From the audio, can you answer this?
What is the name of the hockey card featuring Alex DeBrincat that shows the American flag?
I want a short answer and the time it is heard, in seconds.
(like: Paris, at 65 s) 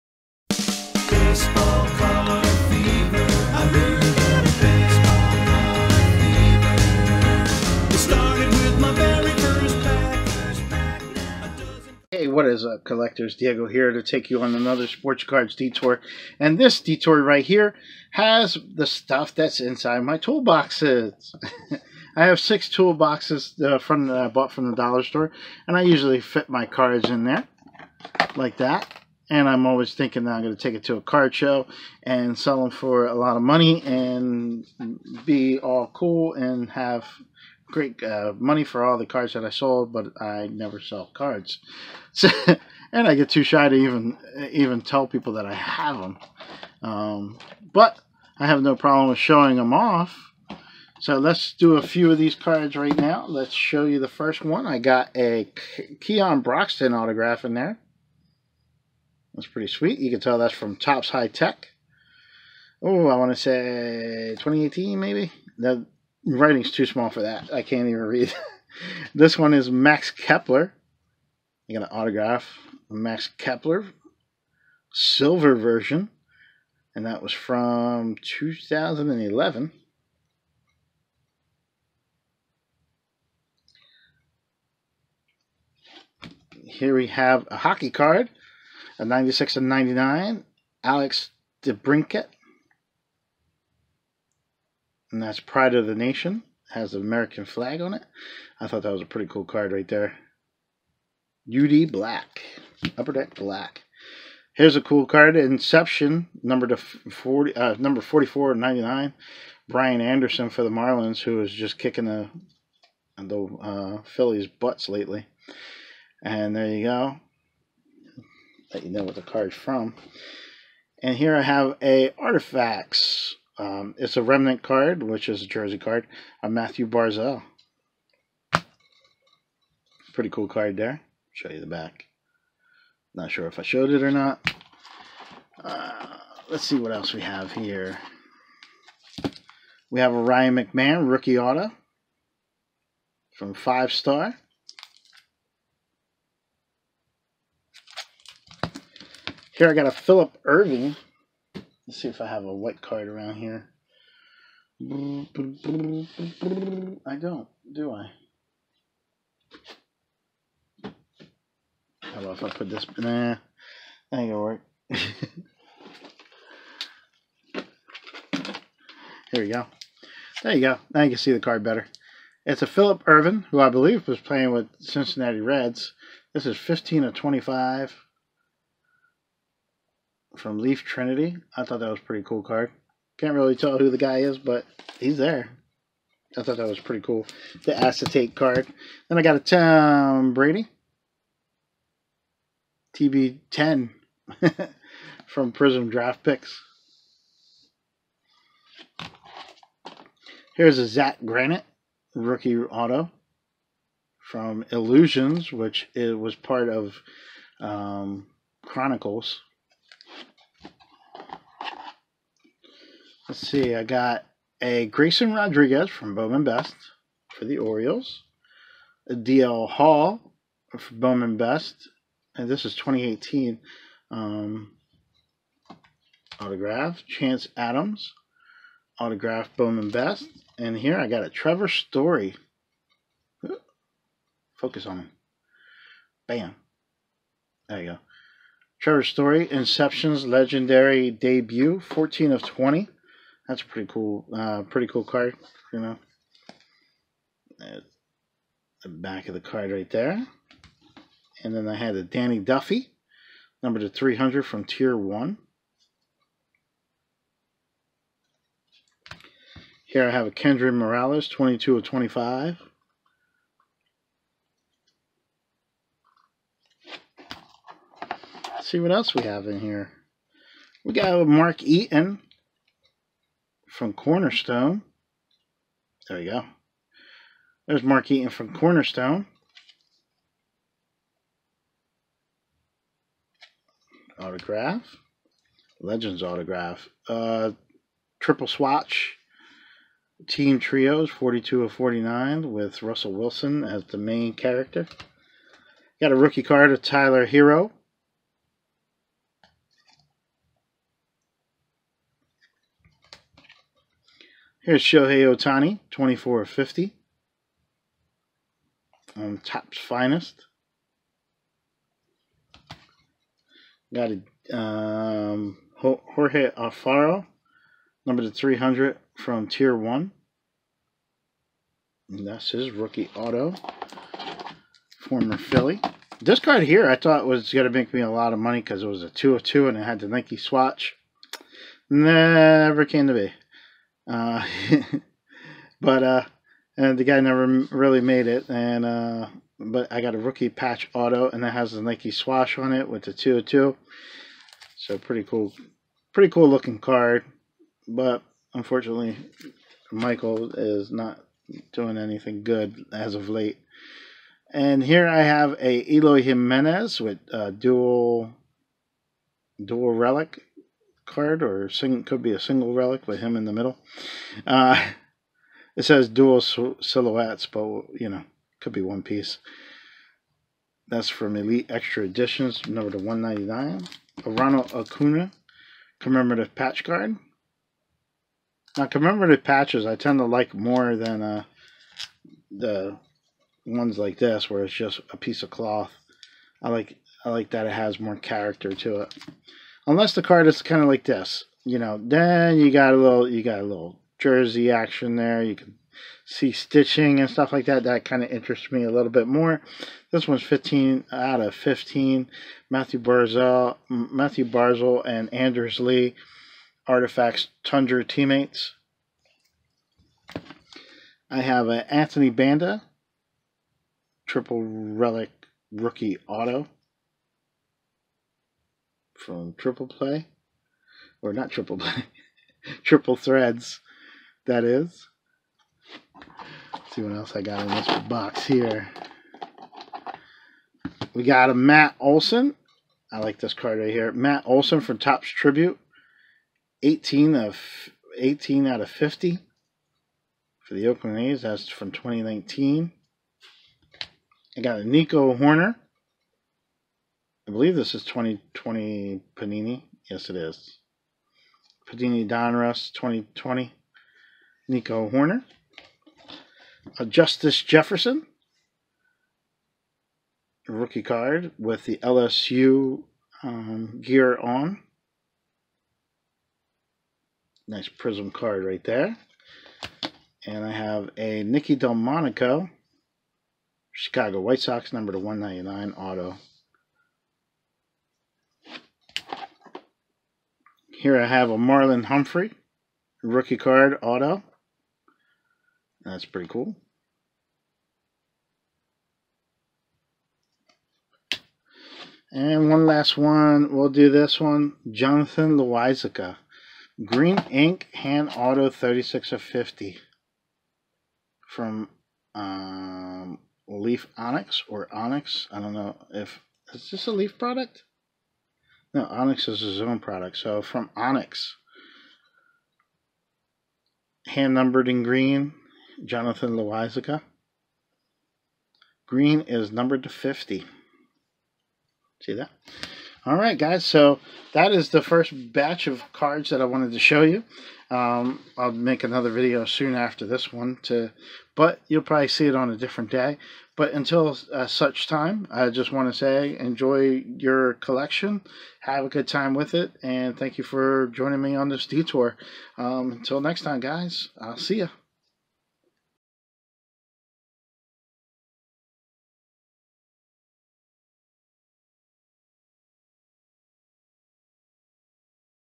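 Pride of the Nation, at 95 s.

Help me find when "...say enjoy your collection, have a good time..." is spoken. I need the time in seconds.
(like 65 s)
536 s.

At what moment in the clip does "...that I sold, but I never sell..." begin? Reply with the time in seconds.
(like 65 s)
39 s.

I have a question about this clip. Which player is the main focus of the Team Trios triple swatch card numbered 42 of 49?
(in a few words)
Russell Wilson.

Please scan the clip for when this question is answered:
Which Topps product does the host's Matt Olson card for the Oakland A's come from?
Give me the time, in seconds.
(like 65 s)
434 s.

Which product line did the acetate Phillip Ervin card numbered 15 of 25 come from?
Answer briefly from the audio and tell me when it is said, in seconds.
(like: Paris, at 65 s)
Leaf Trinity, at 180 s.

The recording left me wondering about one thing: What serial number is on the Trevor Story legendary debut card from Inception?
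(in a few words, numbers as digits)
14 of 20.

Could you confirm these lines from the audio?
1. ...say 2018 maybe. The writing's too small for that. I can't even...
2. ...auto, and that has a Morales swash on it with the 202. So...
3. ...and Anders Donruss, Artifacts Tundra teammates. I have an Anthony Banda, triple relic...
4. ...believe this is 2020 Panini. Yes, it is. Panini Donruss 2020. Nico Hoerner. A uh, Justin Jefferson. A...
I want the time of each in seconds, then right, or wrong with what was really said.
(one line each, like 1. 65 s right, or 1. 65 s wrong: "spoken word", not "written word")
1. 63 s right
2. 340 s wrong: "Nike", not "Morales"
3. 405 s wrong: "Lee", not "Donruss"
4. 447 s right.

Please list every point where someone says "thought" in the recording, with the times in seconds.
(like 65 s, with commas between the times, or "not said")
98 s, 181 s, 186 s, 326 s.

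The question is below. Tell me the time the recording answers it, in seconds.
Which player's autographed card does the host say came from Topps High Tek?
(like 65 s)
56 s.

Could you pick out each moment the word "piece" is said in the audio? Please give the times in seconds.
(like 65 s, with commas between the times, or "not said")
369 s, 385 s.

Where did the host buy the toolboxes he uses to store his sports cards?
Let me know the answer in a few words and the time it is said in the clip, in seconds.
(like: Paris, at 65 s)
dollar store, at 24 s.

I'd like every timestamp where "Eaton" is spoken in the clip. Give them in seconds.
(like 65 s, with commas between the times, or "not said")
271 s, 278 s.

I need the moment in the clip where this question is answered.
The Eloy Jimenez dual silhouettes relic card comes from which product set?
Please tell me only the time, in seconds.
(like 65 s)
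371 s.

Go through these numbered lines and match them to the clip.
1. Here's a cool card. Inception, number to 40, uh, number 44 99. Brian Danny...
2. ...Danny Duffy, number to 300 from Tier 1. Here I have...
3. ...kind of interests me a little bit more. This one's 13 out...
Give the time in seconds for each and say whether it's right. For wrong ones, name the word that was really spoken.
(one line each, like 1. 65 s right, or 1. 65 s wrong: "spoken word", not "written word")
1. 104 s wrong: "Anderson", not "Danny"
2. 252 s right
3. 398 s wrong: "15", not "13".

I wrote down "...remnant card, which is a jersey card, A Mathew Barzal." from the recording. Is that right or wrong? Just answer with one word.
right.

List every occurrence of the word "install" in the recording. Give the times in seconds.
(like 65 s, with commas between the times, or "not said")
not said.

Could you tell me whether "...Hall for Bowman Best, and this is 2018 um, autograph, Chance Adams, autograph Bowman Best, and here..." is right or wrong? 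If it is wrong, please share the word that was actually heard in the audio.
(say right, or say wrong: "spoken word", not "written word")
right.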